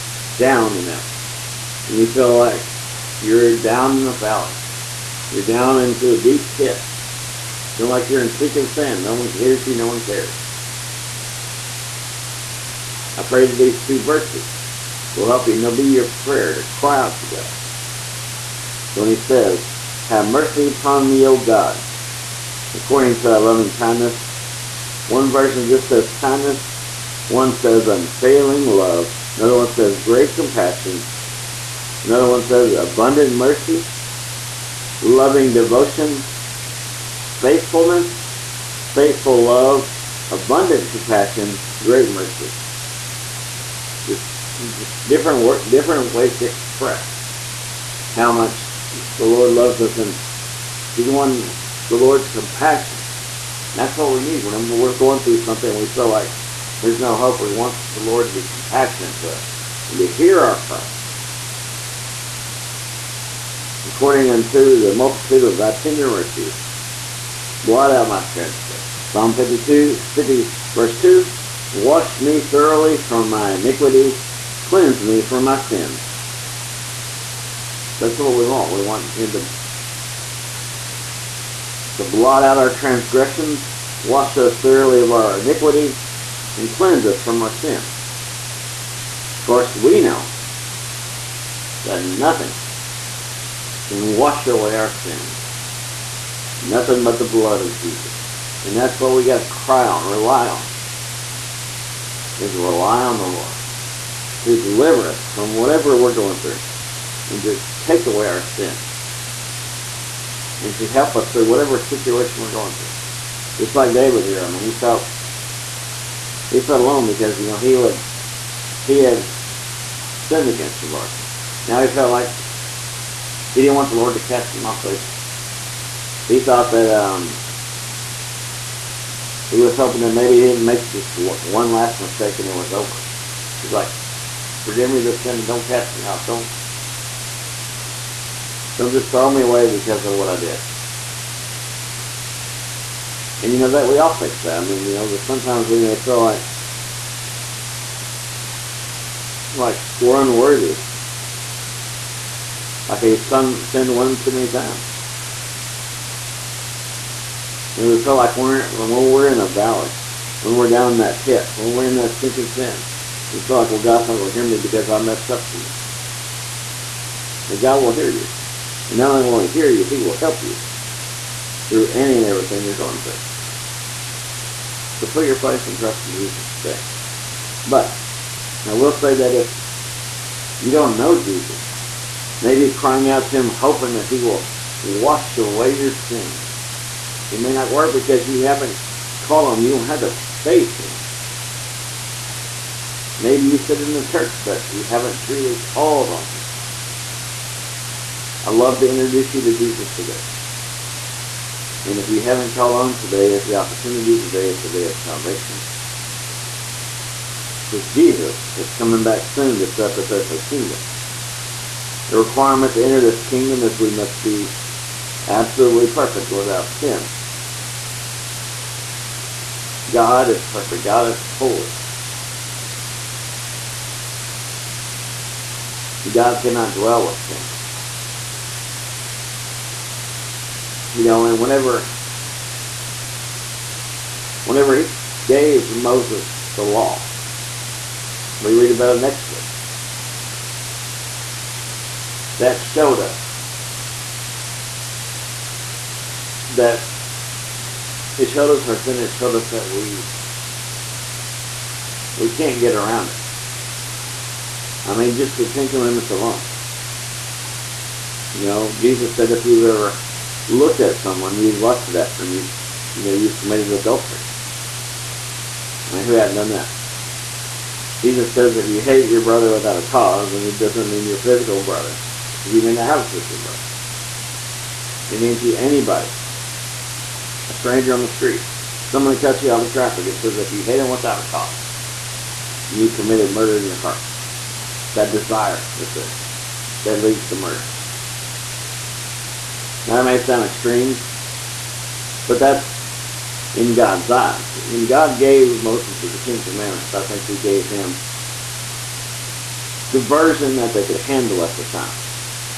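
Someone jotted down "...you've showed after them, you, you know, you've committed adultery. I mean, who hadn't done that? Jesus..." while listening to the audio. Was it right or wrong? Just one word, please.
wrong.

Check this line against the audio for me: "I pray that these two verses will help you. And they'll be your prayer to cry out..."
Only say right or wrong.
right.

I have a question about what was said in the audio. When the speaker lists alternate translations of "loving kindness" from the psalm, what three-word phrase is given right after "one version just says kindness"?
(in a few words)
Unfailing love.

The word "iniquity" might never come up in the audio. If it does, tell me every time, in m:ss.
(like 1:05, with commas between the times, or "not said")
1:13, 1:25.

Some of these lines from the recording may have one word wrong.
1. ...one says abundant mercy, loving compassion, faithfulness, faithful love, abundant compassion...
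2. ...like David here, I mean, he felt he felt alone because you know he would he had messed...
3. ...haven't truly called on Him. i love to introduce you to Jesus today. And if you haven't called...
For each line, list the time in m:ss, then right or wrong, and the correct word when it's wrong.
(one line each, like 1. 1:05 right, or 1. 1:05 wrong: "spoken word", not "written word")
1. 0:32 wrong: "devotion", not "compassion"
2. 1:53 wrong: "sinned", not "messed"
3. 3:14 right.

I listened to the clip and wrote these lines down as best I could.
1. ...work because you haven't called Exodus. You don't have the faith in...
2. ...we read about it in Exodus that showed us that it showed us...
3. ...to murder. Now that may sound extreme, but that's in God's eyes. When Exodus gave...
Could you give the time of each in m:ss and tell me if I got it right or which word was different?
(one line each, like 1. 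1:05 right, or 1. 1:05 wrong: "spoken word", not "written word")
1. 3:07 wrong: "Him", not "Exodus"
2. 3:58 right
3. 4:47 wrong: "God", not "Exodus".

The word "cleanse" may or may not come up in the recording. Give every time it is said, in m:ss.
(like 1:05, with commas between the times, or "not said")
1:14, 1:26.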